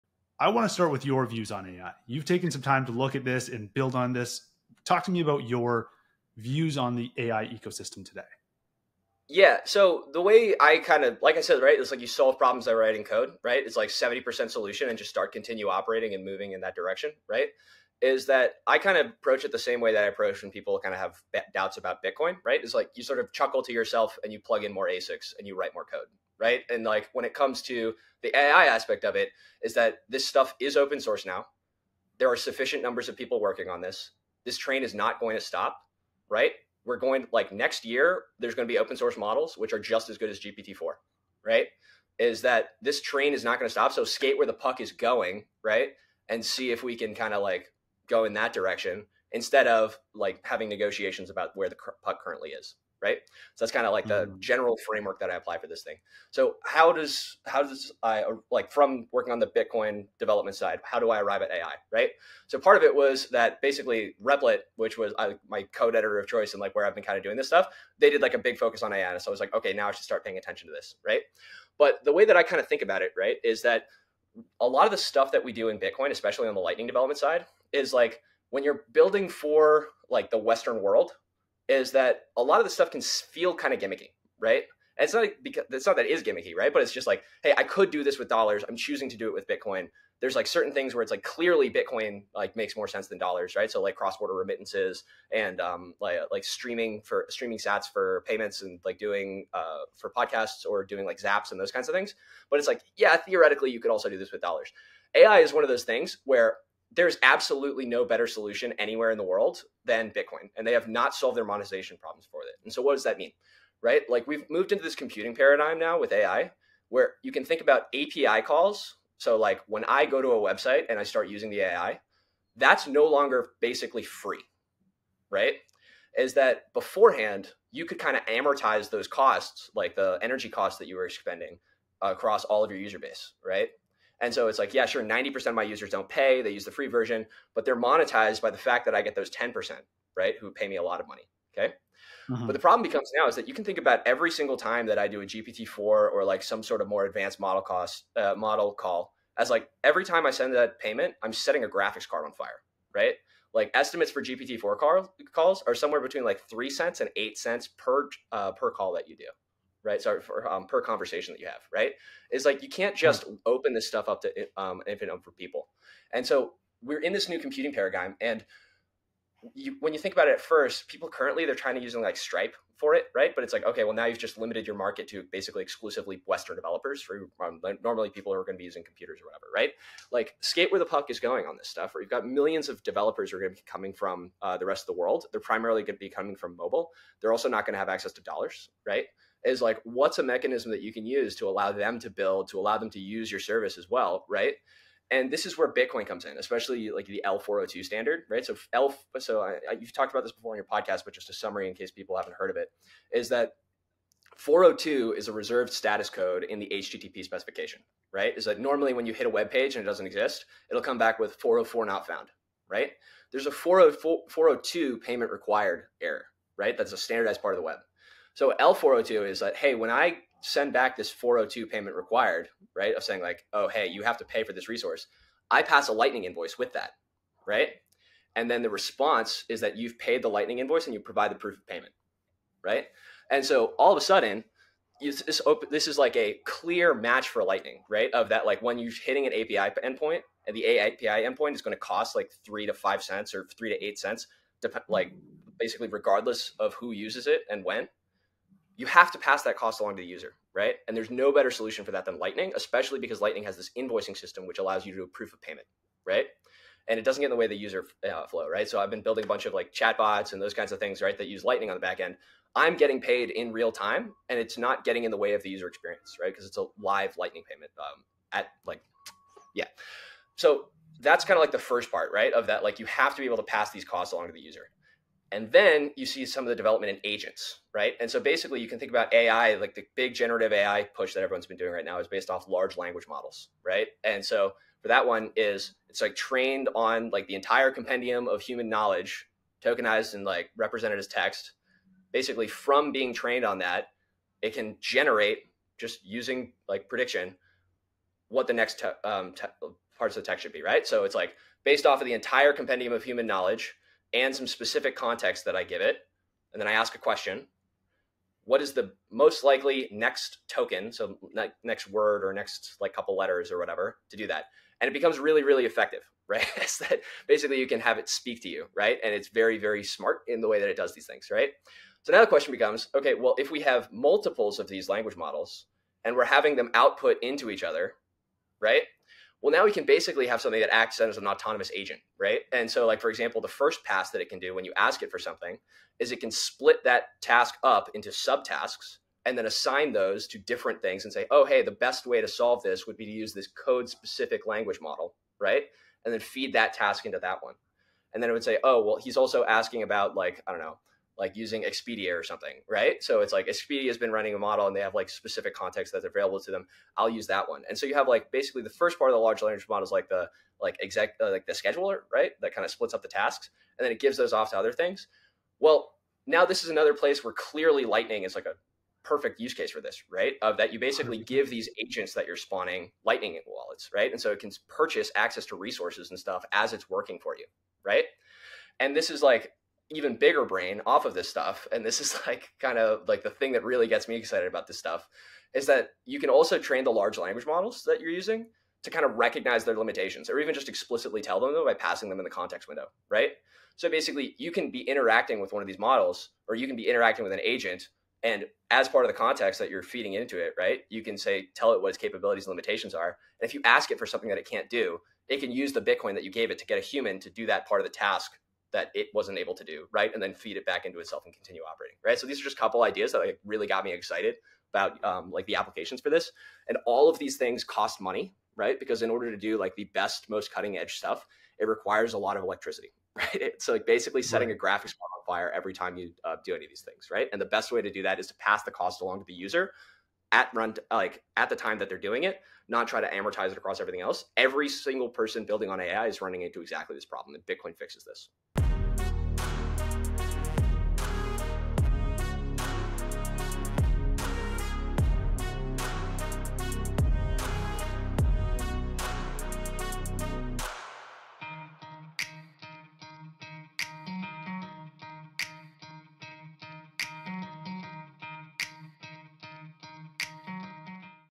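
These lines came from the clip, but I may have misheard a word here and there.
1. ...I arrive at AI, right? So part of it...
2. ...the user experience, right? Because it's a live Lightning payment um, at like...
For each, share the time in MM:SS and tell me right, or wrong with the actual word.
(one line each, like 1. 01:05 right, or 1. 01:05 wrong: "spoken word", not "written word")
1. 01:01 right
2. 04:25 right.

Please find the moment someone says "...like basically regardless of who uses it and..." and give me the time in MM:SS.
04:04.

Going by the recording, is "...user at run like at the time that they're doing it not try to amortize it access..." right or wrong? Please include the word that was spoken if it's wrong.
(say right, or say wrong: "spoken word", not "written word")
wrong: "across", not "access".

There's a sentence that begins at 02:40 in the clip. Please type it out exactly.
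Sorry for um, per conversation that you have, right?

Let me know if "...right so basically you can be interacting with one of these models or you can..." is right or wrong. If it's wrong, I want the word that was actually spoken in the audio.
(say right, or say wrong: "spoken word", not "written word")
right.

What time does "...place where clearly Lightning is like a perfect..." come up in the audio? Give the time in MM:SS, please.
06:06.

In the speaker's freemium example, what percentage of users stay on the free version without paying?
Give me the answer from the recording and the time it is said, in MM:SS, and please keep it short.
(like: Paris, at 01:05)
90%, at 02:15.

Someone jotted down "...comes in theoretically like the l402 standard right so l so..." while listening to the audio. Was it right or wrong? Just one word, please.
wrong.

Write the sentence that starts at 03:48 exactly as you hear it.
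And then the response is that you've paid the Lightning invoice and you provide the proof of payment, right?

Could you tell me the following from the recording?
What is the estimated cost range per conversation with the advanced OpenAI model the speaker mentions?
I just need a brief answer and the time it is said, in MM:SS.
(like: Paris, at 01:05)
3 to 8 cents, at 02:36.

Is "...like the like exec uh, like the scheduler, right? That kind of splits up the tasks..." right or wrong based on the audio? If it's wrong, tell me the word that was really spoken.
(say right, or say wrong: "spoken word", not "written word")
right.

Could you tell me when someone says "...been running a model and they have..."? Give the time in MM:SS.
05:53.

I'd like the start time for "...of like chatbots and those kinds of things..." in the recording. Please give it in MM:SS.
04:19.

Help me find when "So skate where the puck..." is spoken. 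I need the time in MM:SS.
00:43.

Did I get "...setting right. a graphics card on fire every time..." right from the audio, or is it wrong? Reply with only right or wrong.
right.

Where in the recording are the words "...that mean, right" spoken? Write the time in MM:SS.
01:53.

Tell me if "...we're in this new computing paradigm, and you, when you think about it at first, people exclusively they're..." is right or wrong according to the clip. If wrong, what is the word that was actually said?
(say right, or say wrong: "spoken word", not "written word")
wrong: "currently", not "exclusively".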